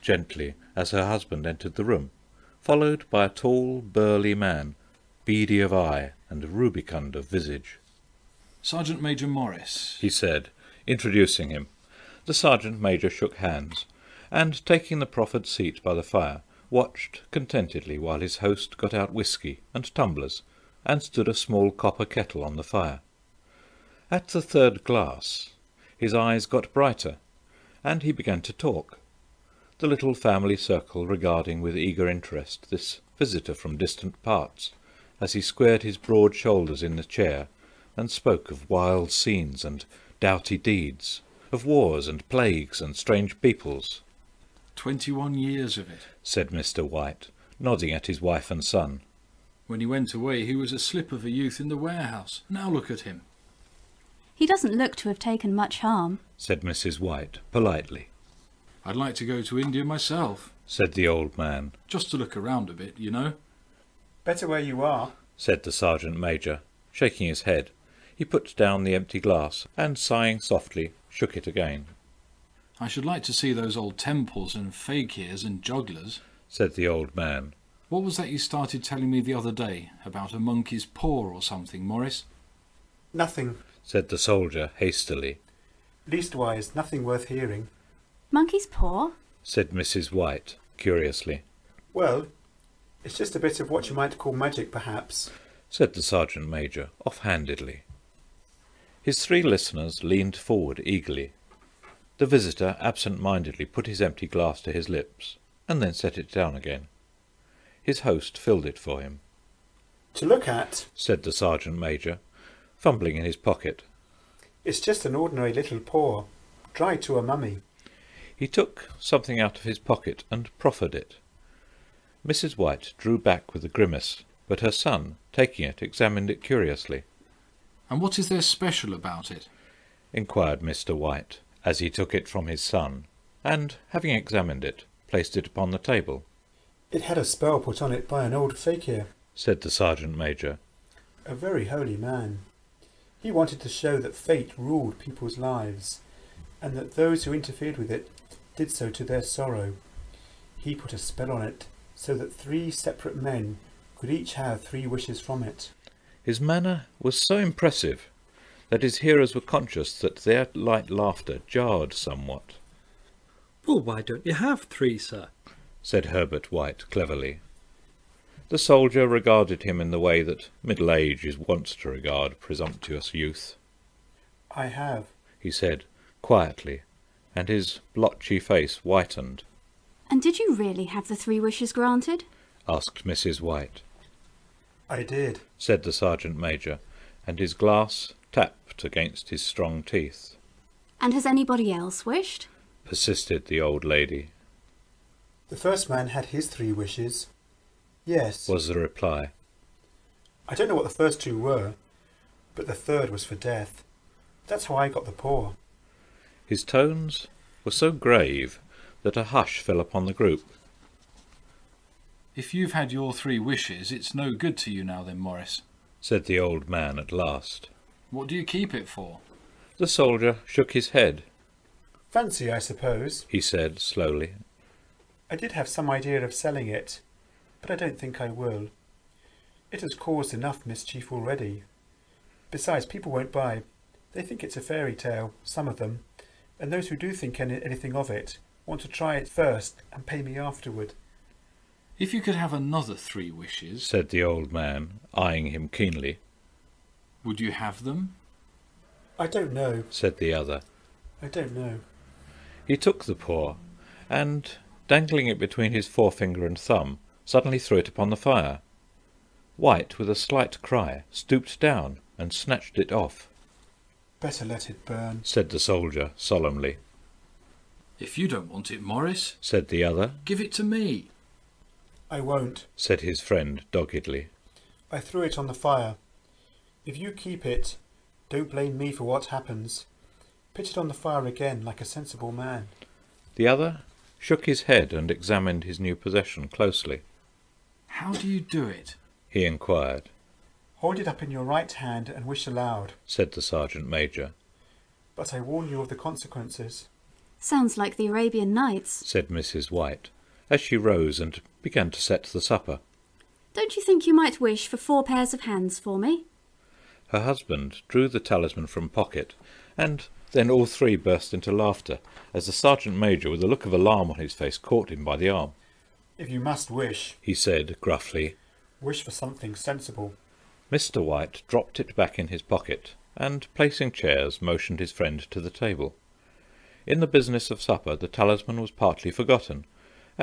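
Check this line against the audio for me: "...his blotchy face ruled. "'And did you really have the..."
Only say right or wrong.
wrong.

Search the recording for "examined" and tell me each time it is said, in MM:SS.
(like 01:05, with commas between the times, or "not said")
02:05, 02:14, 04:45.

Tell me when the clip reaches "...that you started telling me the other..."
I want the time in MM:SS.
01:18.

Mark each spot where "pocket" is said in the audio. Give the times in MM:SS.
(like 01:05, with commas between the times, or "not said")
01:53, 01:59, 05:08, 05:22.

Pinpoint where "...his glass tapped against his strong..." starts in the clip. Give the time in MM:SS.
03:07.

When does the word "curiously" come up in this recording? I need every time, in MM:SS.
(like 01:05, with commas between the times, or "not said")
01:30, 02:06.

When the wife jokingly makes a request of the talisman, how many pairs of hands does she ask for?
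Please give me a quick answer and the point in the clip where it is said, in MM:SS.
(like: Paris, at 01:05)
4, at 05:04.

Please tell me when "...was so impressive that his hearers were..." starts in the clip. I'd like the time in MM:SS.
02:36.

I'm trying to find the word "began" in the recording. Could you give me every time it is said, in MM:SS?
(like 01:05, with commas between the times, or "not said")
00:28, 05:01.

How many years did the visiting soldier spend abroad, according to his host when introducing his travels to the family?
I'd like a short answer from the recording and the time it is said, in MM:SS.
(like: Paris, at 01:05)
21, at 00:44.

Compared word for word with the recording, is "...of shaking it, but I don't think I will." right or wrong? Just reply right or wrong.
wrong.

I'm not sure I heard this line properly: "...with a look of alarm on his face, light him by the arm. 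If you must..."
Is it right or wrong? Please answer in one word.
wrong.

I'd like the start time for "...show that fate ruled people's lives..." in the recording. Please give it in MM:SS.
02:23.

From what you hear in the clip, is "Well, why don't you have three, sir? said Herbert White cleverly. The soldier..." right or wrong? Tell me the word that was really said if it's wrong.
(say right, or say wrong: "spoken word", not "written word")
right.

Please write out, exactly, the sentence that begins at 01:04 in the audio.
Better where you are, said the sergeant major, shaking his head.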